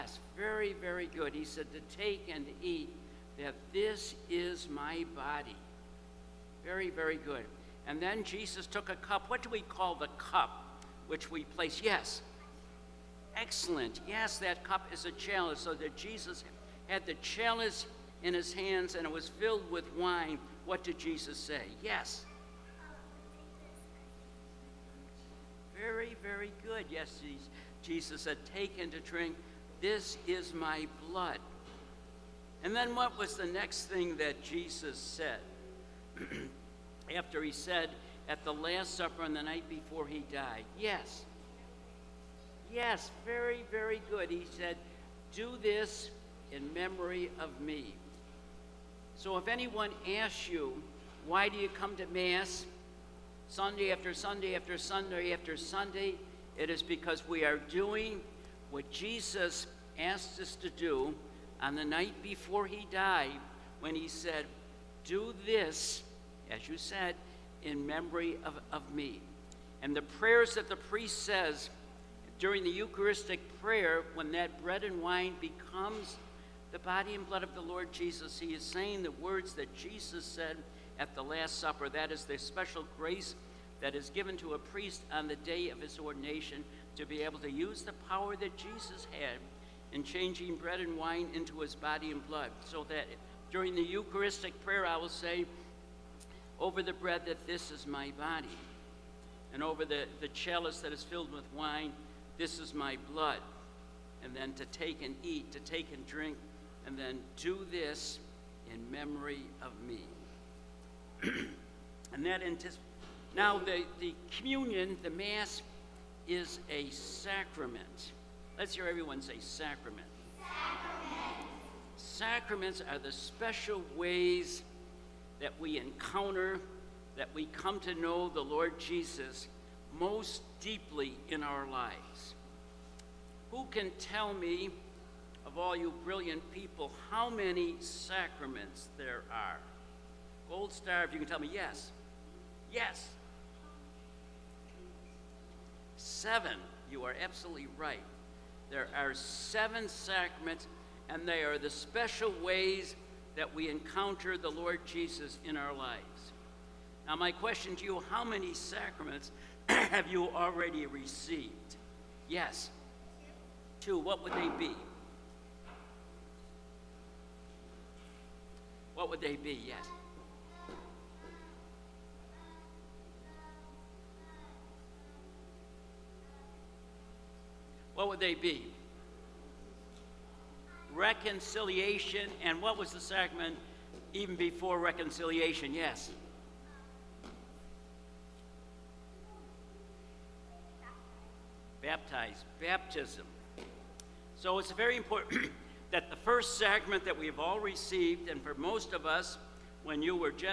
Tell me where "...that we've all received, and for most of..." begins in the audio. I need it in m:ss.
3:17.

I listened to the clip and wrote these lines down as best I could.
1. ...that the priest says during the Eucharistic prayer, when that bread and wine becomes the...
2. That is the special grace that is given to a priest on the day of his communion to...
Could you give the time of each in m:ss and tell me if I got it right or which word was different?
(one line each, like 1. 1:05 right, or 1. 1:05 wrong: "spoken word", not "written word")
1. 1:10 right
2. 1:21 wrong: "ordination", not "communion".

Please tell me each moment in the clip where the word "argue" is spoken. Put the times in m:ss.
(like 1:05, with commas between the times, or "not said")
not said.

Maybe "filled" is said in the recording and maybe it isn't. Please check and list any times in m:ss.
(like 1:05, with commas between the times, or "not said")
0:19, 1:41.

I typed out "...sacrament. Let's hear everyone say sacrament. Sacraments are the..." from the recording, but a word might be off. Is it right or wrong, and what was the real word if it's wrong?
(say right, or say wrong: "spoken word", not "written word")
right.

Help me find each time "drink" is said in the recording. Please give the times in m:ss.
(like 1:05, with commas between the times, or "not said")
0:29, 1:46.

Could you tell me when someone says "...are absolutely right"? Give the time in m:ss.
2:27.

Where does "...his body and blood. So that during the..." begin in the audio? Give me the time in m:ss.
1:31.